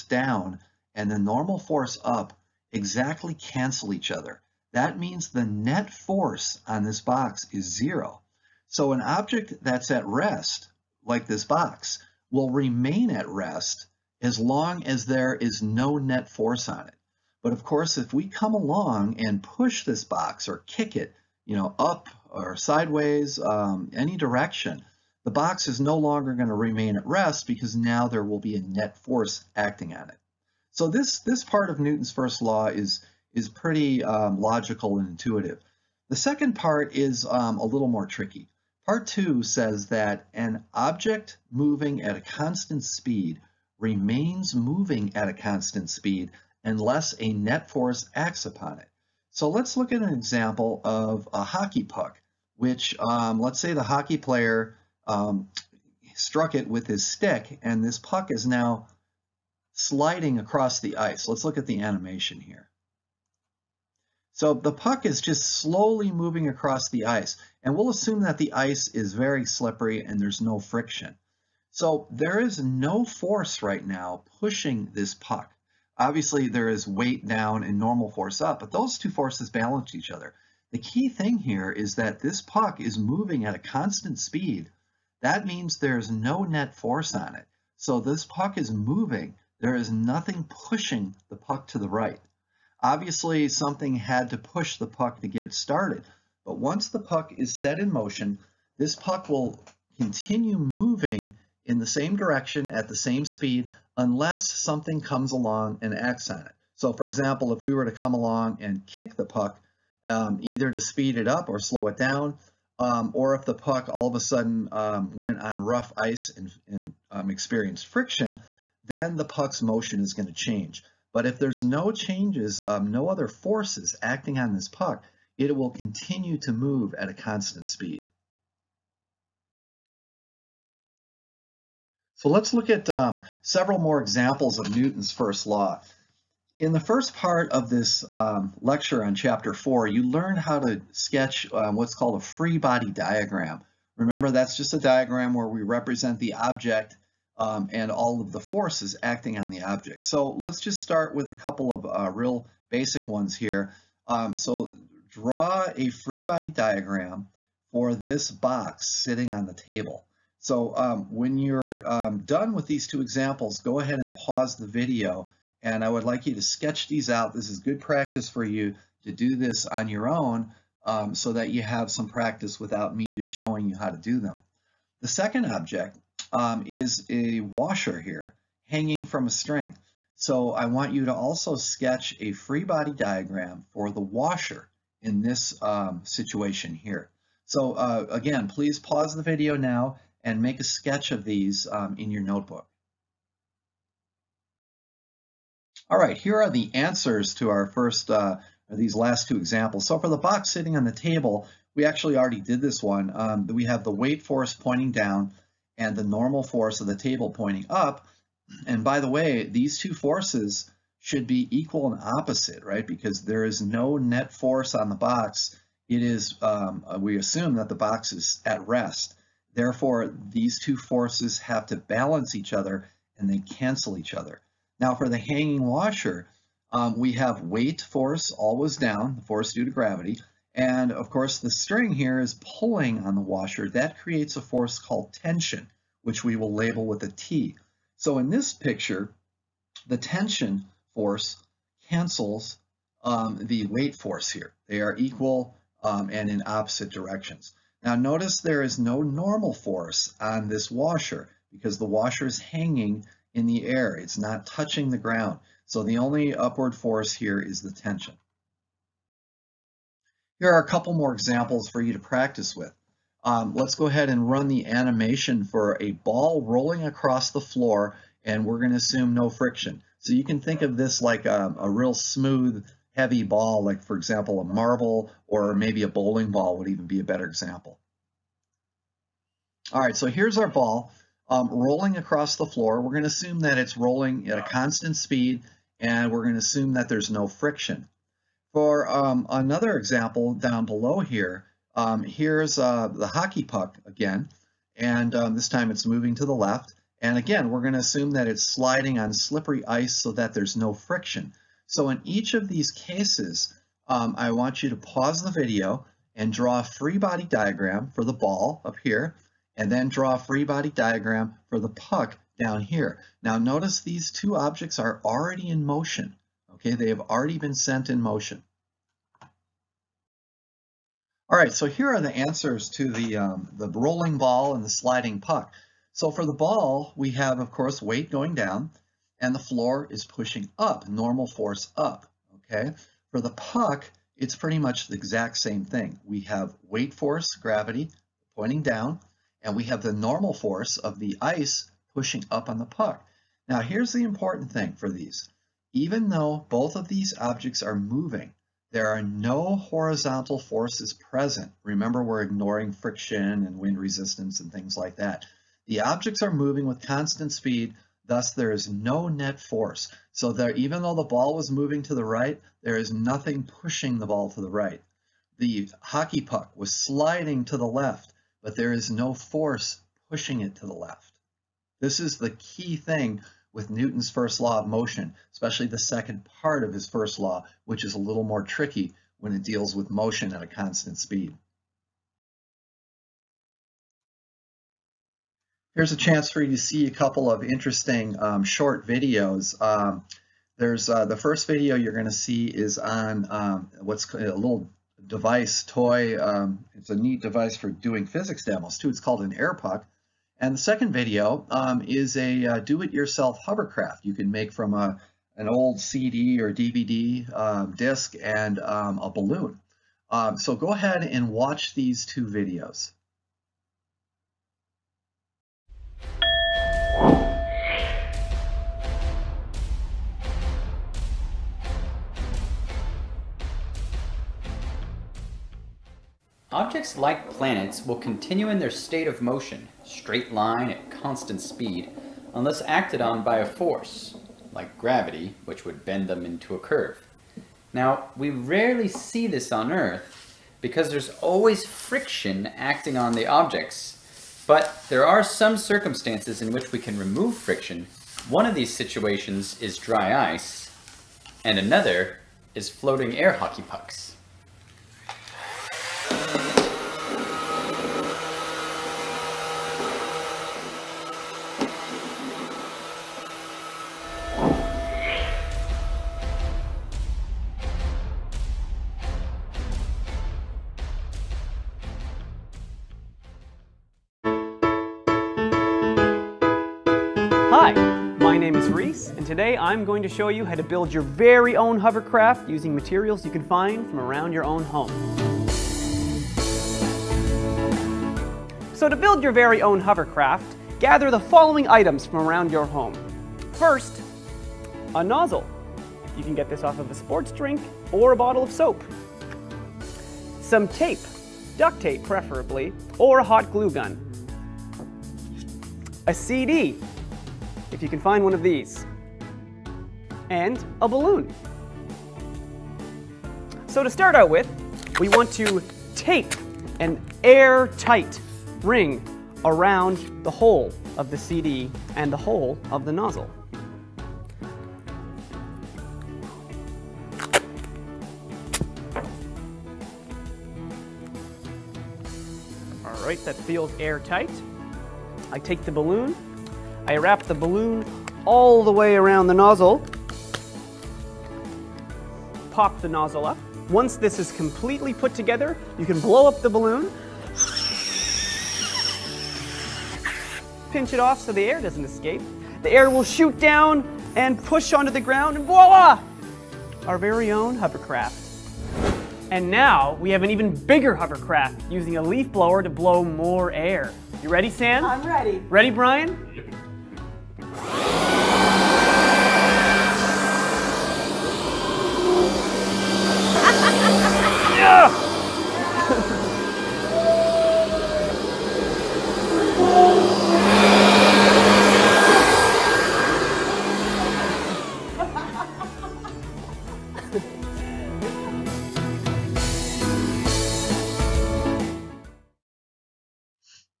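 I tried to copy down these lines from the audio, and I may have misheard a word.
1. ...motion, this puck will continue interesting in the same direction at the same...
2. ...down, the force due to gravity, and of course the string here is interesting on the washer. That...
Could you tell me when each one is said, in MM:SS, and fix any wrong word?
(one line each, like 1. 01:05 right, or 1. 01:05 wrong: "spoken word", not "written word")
1. 01:37 wrong: "moving", not "interesting"
2. 03:48 wrong: "pulling", not "interesting".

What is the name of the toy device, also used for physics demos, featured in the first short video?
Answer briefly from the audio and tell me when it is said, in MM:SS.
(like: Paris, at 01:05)
air puck, at 06:39.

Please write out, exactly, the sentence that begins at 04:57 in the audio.
And again, we're gonna assume that it's sliding on slippery ice so that there's no friction.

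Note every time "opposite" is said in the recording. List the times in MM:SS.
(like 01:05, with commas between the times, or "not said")
03:32, 04:06.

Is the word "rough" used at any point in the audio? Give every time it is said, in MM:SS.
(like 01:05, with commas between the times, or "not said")
01:55.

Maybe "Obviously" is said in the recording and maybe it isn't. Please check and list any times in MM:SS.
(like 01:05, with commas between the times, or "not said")
01:15, 01:32.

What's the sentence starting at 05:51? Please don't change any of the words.
Remember, we're ignoring friction and wind resistance and things like that.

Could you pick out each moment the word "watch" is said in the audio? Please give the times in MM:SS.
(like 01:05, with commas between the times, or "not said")
06:51.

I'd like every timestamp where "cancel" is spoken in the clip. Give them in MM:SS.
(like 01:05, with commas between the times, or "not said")
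00:03, 03:43, 04:01.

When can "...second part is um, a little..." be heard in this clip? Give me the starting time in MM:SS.
00:36.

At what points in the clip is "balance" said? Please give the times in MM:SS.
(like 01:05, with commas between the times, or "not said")
01:19, 03:41.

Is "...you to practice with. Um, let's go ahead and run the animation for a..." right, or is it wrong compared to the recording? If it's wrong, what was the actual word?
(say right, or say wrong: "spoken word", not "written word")
right.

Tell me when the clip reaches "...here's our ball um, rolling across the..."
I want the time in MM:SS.
04:40.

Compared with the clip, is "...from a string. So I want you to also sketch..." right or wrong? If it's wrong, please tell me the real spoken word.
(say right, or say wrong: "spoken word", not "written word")
right.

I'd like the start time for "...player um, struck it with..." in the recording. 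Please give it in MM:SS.
00:54.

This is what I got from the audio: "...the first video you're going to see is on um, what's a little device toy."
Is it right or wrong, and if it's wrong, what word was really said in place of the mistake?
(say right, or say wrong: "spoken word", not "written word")
right.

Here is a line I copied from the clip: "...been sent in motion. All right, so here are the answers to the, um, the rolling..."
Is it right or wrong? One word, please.
right.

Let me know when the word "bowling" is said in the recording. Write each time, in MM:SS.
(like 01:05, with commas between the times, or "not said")
04:35.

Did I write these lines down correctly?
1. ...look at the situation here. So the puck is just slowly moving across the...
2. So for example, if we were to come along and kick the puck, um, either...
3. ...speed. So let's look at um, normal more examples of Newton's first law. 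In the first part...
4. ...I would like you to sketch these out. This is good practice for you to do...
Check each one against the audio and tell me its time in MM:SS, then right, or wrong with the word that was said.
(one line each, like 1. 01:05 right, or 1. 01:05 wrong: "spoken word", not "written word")
1. 01:01 wrong: "animation", not "situation"
2. 01:46 right
3. 02:07 wrong: "several", not "normal"
4. 02:45 right.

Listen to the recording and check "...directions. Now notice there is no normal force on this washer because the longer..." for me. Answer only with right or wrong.
wrong.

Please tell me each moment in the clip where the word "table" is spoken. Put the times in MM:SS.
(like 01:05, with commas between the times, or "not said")
02:39, 03:20, 03:26.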